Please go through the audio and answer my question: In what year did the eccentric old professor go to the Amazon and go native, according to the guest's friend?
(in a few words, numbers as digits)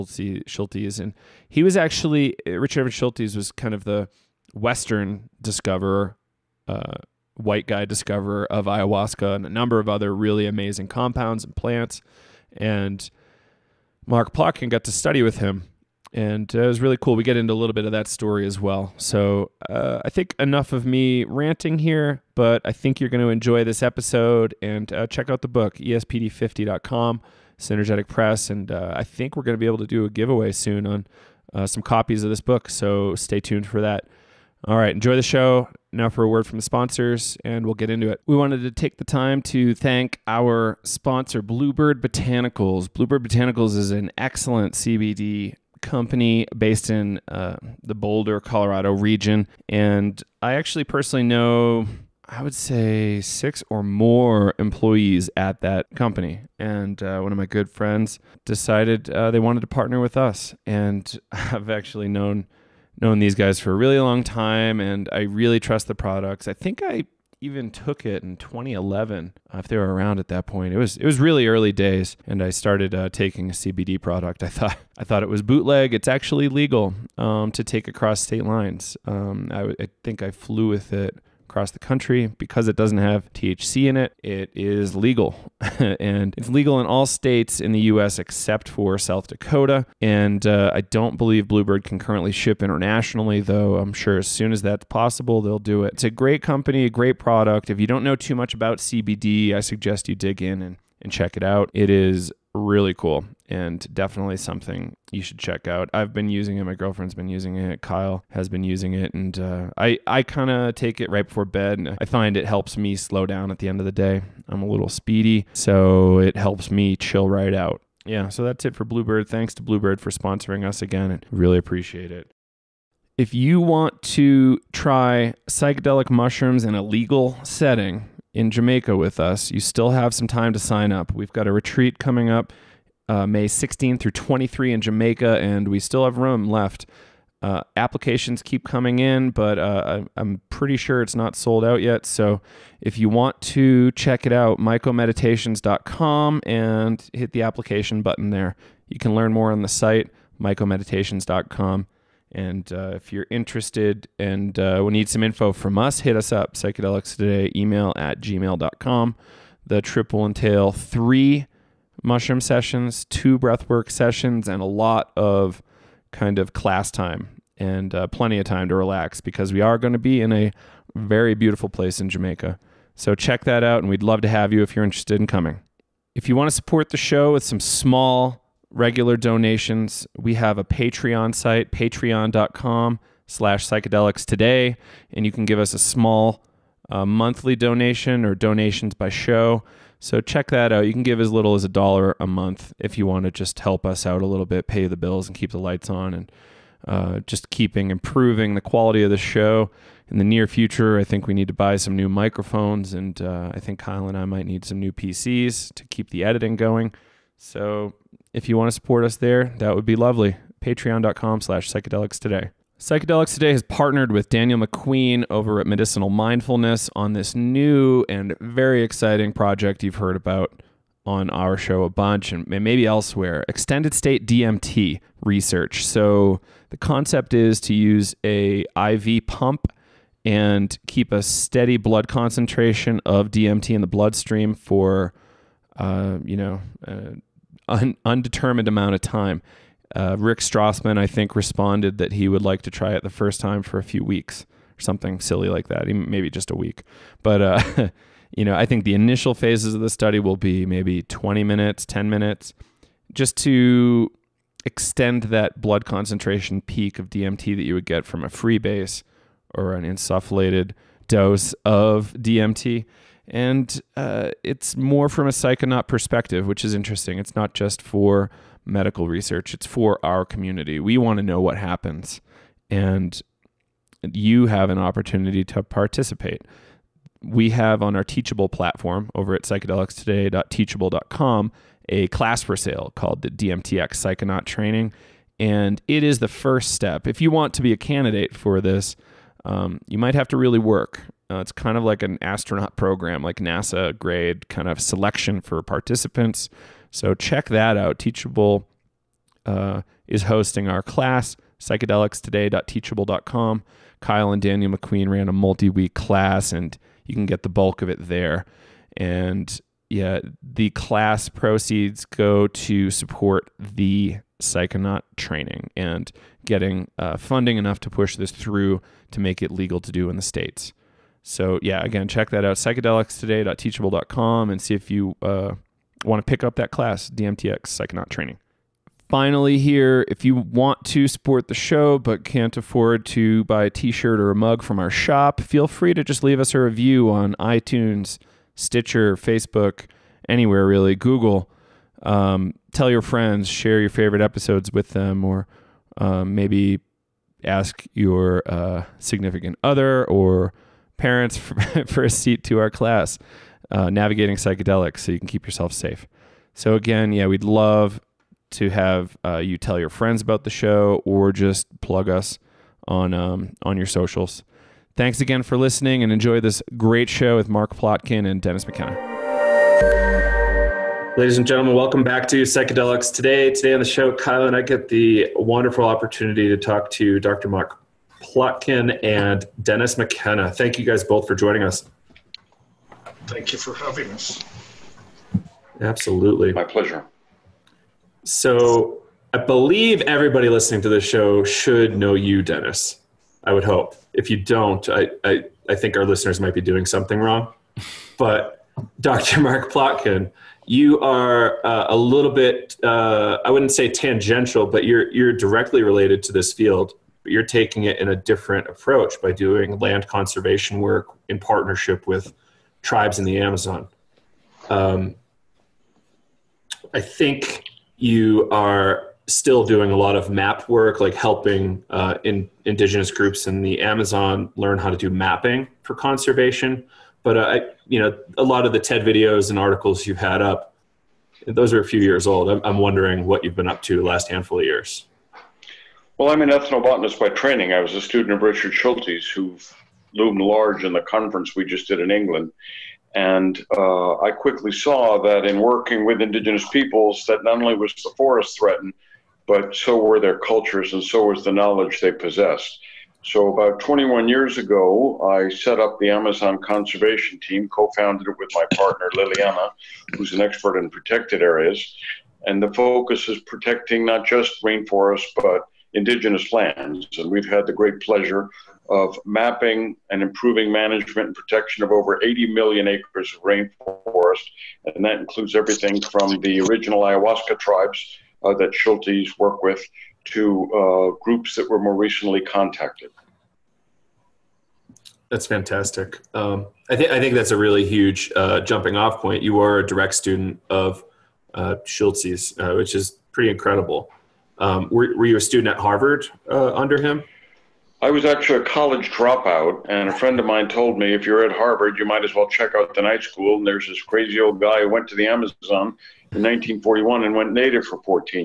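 1941.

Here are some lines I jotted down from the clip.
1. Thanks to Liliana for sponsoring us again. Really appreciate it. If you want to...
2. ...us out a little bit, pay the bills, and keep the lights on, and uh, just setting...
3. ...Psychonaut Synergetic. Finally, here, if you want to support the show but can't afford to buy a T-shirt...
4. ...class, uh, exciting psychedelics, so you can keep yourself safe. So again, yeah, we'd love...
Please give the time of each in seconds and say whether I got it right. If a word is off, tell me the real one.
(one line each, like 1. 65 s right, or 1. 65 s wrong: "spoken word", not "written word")
1. 119 s wrong: "Bluebird", not "Liliana"
2. 193 s wrong: "keeping", not "setting"
3. 327 s wrong: "Training", not "Synergetic"
4. 352 s wrong: "navigating", not "exciting".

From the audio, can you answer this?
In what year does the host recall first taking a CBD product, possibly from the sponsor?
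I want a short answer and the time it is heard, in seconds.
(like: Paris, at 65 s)
2011, at 68 s.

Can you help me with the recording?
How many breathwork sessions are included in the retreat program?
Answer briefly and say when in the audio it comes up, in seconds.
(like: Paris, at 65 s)
2, at 163 s.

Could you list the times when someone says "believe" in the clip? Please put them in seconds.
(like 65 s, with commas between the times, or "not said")
91 s, 389 s.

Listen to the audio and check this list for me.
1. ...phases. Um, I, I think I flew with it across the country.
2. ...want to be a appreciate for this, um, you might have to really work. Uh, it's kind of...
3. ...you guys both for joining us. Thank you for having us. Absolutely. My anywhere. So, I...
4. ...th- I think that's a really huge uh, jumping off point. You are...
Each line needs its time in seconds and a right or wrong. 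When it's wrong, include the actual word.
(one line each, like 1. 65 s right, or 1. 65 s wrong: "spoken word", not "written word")
1. 78 s wrong: "lines", not "phases"
2. 287 s wrong: "candidate", not "appreciate"
3. 380 s wrong: "pleasure", not "anywhere"
4. 486 s right.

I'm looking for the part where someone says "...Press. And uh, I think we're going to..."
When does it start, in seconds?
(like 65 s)
28 s.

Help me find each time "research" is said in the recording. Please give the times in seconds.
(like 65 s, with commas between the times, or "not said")
225 s, 269 s.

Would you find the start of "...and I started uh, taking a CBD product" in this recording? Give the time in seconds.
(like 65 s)
72 s.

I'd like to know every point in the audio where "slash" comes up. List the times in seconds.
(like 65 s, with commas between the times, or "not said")
183 s, 211 s.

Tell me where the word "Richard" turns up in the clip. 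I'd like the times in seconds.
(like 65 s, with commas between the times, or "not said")
2 s, 438 s.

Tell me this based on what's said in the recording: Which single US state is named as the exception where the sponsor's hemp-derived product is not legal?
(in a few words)
South Dakota.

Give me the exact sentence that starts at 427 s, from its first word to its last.
But uh, I, you know, a lot of the TED videos and articles you've had up, those are a few years old.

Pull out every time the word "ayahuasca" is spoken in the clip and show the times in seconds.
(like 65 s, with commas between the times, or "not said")
8 s, 477 s.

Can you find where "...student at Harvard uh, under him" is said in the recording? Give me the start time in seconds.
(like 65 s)
495 s.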